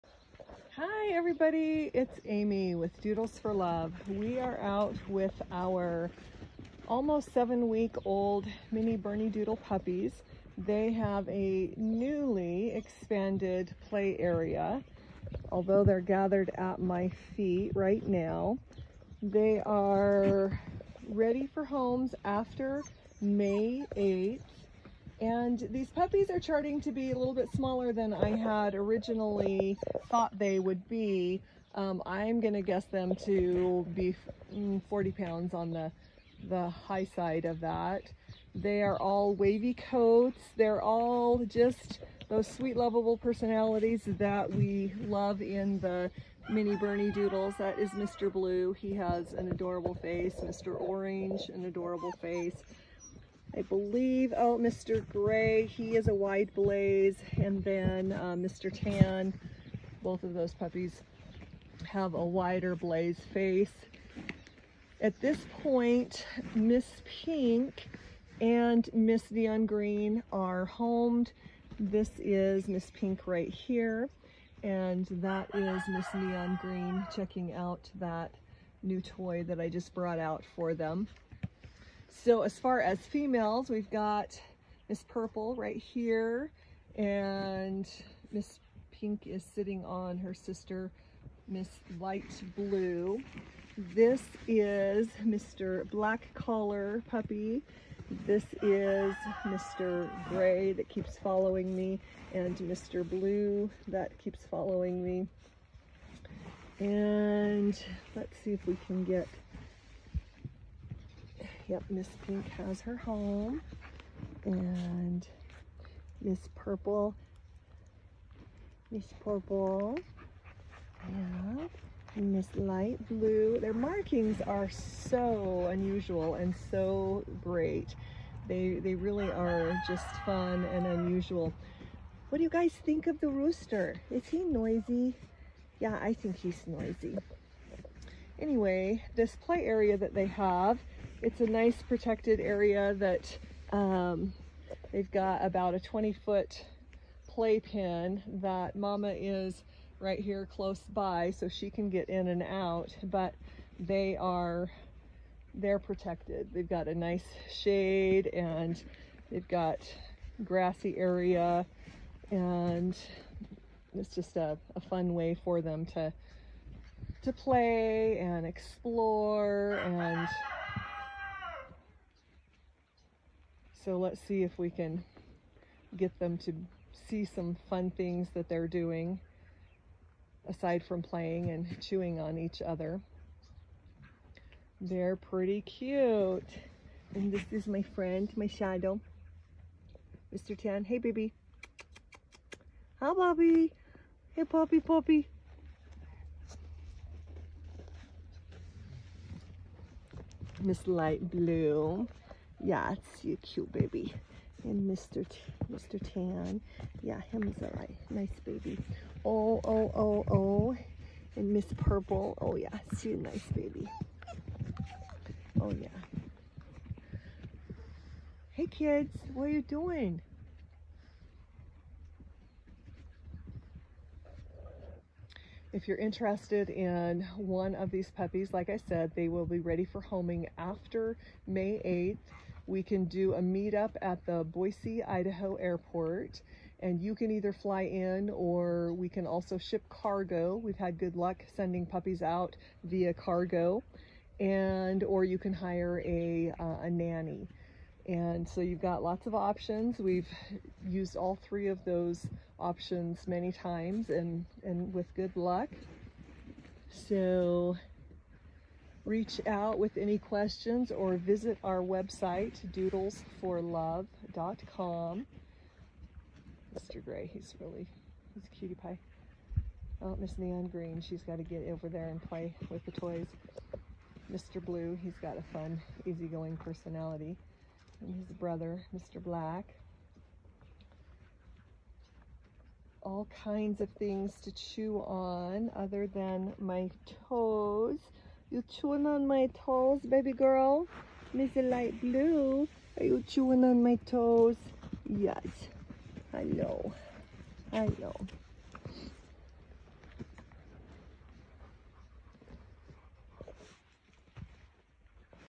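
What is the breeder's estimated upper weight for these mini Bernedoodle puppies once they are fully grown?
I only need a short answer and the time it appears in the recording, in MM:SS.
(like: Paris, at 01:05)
40 pounds, at 00:34.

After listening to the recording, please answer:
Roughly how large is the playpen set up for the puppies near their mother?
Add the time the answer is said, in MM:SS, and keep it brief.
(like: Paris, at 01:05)
20 foot, at 02:25.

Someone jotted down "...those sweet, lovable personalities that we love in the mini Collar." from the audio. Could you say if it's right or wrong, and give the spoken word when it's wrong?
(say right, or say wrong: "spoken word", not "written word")
wrong: "Bernedoodles", not "Collar".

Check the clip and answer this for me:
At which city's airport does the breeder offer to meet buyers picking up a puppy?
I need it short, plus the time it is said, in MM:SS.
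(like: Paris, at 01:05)
Boise, Idaho, at 03:54.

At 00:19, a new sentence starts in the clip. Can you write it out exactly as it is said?
They are ready for homes after May 8th.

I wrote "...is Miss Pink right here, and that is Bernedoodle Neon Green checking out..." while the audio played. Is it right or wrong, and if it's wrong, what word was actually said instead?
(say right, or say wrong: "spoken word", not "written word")
wrong: "Miss", not "Bernedoodle".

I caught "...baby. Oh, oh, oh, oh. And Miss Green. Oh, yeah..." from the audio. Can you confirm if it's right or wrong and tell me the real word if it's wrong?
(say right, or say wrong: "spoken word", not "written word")
wrong: "Purple", not "Green".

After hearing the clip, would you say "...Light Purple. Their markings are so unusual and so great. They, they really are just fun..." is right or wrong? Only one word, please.
wrong.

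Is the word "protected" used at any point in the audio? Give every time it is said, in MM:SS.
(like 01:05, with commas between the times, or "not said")
02:21, 02:35.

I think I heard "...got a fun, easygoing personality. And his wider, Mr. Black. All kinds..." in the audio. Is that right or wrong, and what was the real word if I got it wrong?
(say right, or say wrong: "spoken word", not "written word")
wrong: "brother", not "wider".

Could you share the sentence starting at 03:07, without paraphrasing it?
And this is my friend, my shadow, Mr.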